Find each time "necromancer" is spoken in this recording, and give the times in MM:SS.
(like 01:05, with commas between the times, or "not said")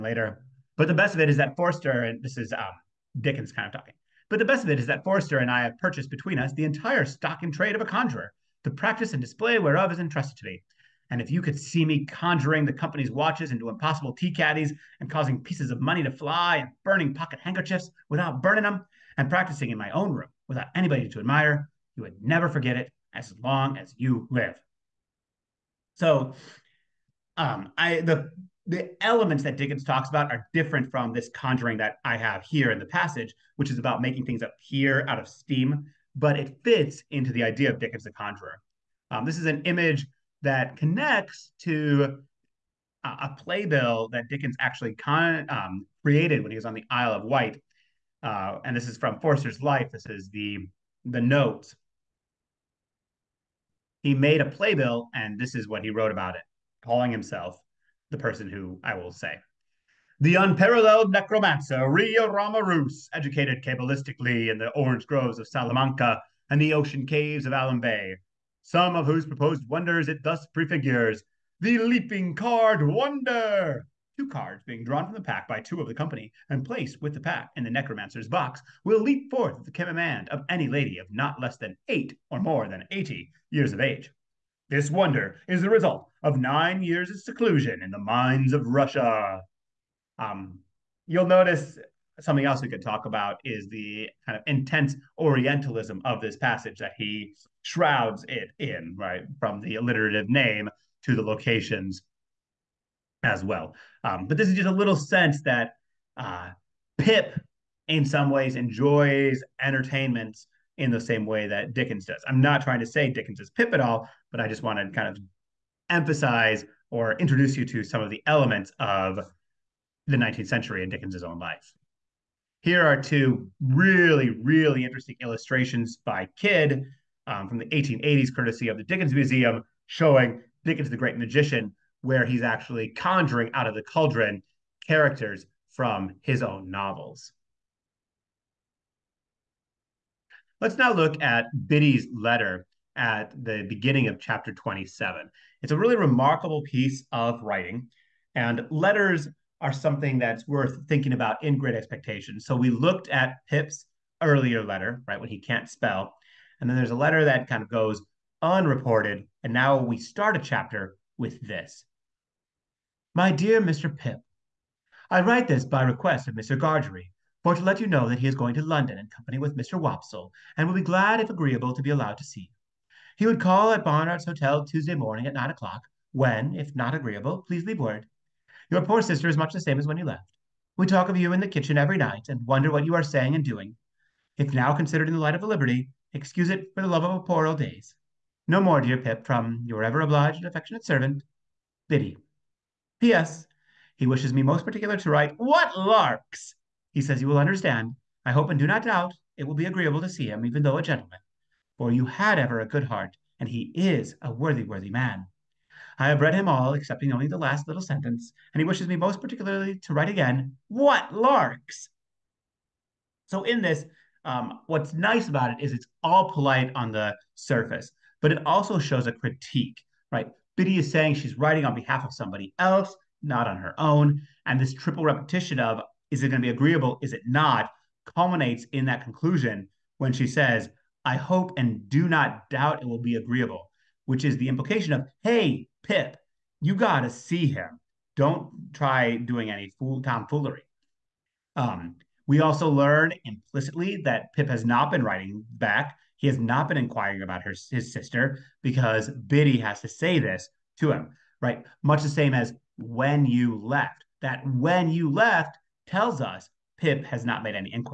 01:01, 01:17.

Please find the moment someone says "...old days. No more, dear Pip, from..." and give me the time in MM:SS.
03:07.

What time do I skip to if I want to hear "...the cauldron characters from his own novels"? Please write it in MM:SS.
02:13.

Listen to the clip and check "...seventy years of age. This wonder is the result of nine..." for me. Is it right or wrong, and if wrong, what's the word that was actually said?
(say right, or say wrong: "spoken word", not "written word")
wrong: "eighty", not "seventy".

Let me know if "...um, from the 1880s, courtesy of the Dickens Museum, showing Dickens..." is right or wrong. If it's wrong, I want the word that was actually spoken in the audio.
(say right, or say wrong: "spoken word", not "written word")
right.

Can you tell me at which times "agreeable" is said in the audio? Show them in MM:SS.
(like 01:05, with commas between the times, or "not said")
02:51, 02:56, 03:19, 03:46, 03:53.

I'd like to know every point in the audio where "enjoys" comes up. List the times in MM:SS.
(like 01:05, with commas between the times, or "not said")
01:48.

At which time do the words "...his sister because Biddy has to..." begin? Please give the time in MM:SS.
04:07.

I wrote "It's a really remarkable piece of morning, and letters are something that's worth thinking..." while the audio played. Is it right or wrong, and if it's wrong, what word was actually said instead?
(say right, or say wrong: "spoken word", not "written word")
wrong: "writing", not "morning".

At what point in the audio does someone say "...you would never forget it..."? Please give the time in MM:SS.
00:21.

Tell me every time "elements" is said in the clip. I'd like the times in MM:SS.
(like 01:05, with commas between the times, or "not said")
00:29, 01:58.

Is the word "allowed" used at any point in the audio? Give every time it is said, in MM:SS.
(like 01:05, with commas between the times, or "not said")
02:51.